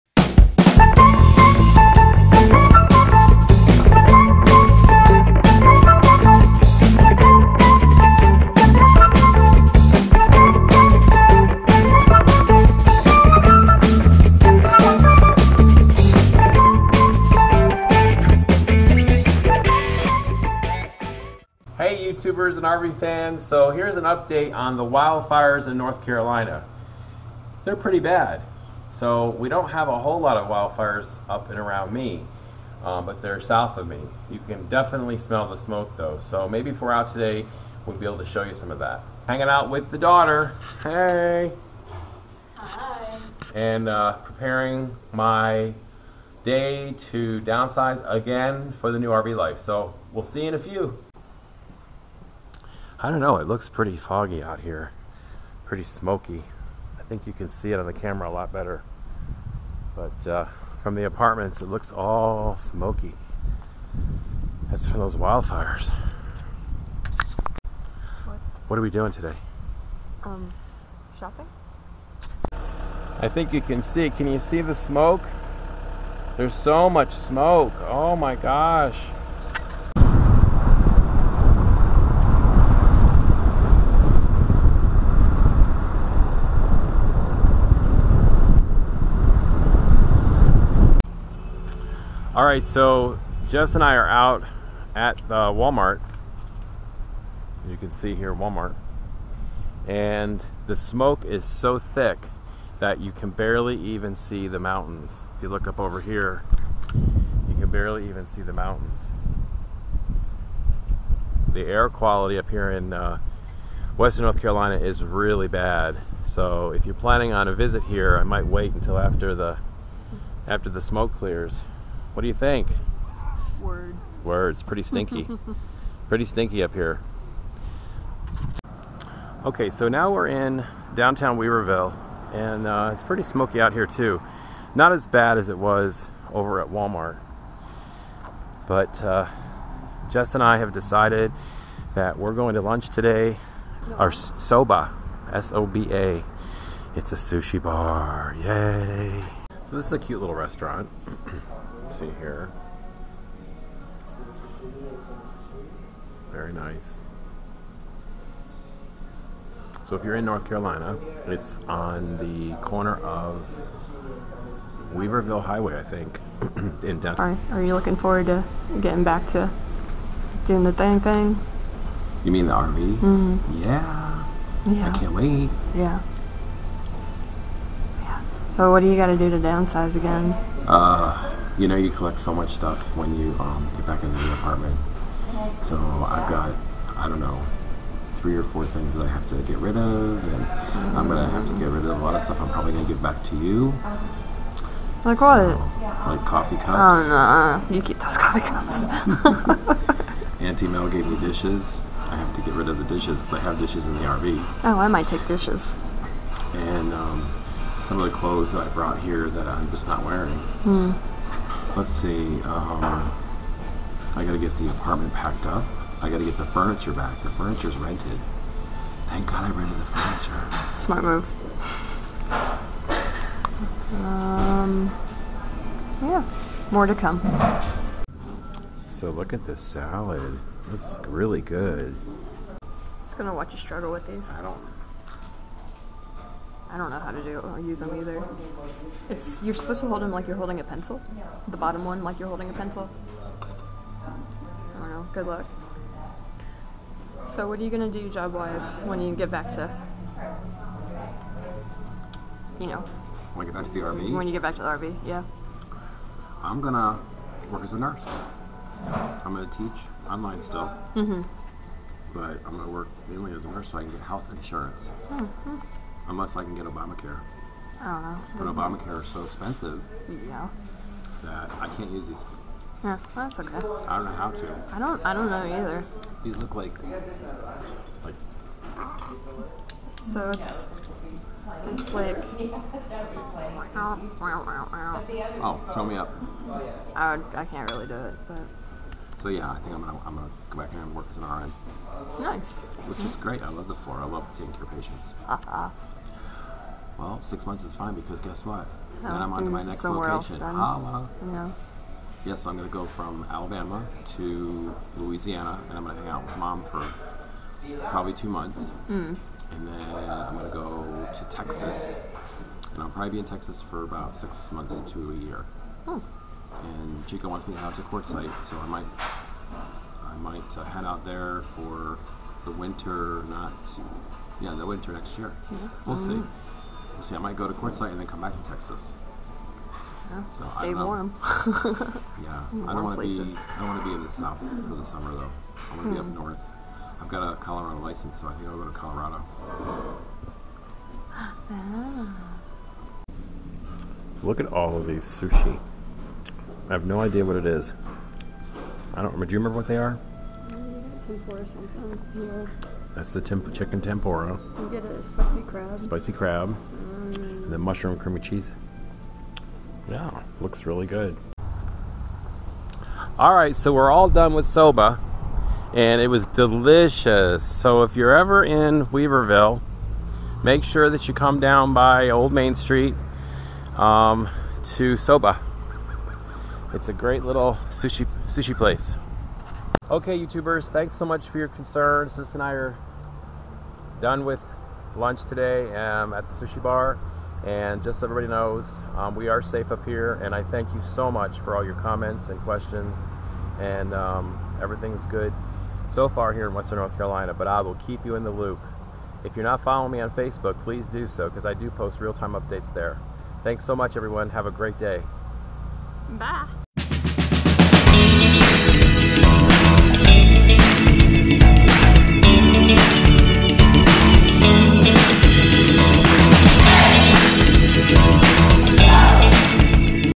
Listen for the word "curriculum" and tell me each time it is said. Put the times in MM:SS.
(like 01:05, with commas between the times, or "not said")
not said.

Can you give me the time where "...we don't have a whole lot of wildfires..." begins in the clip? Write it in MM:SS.
00:29.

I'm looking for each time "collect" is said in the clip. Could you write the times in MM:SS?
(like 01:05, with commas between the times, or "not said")
03:01.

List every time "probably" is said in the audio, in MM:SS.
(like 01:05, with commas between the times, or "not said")
03:12, 05:07, 05:12.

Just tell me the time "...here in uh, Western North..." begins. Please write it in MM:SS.
01:52.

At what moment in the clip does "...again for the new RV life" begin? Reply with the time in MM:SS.
00:48.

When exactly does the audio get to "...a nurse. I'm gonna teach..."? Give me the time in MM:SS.
04:17.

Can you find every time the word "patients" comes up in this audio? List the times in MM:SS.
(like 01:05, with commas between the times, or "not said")
04:54.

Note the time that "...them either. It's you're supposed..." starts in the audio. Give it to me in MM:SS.
03:57.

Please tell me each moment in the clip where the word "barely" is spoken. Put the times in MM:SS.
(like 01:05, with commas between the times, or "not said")
01:43, 01:47.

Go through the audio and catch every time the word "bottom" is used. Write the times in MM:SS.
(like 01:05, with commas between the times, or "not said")
04:01.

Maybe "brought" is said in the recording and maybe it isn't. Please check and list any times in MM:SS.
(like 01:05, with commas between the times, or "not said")
03:28.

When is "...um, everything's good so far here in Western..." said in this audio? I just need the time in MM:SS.
06:33.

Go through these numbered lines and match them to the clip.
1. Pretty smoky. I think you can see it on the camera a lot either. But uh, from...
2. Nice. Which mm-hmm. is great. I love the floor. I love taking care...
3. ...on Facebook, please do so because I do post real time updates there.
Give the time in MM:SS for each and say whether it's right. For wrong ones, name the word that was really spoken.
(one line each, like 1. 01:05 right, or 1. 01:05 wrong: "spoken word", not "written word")
1. 00:55 wrong: "better", not "either"
2. 04:52 right
3. 06:39 right.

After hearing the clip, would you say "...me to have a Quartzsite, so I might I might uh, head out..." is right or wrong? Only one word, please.
right.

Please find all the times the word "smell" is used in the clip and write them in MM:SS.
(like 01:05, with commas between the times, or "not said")
00:35.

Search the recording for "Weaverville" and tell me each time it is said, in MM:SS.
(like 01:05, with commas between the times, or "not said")
02:11, 02:44, 06:08.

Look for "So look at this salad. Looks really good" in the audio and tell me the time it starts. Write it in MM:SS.
03:48.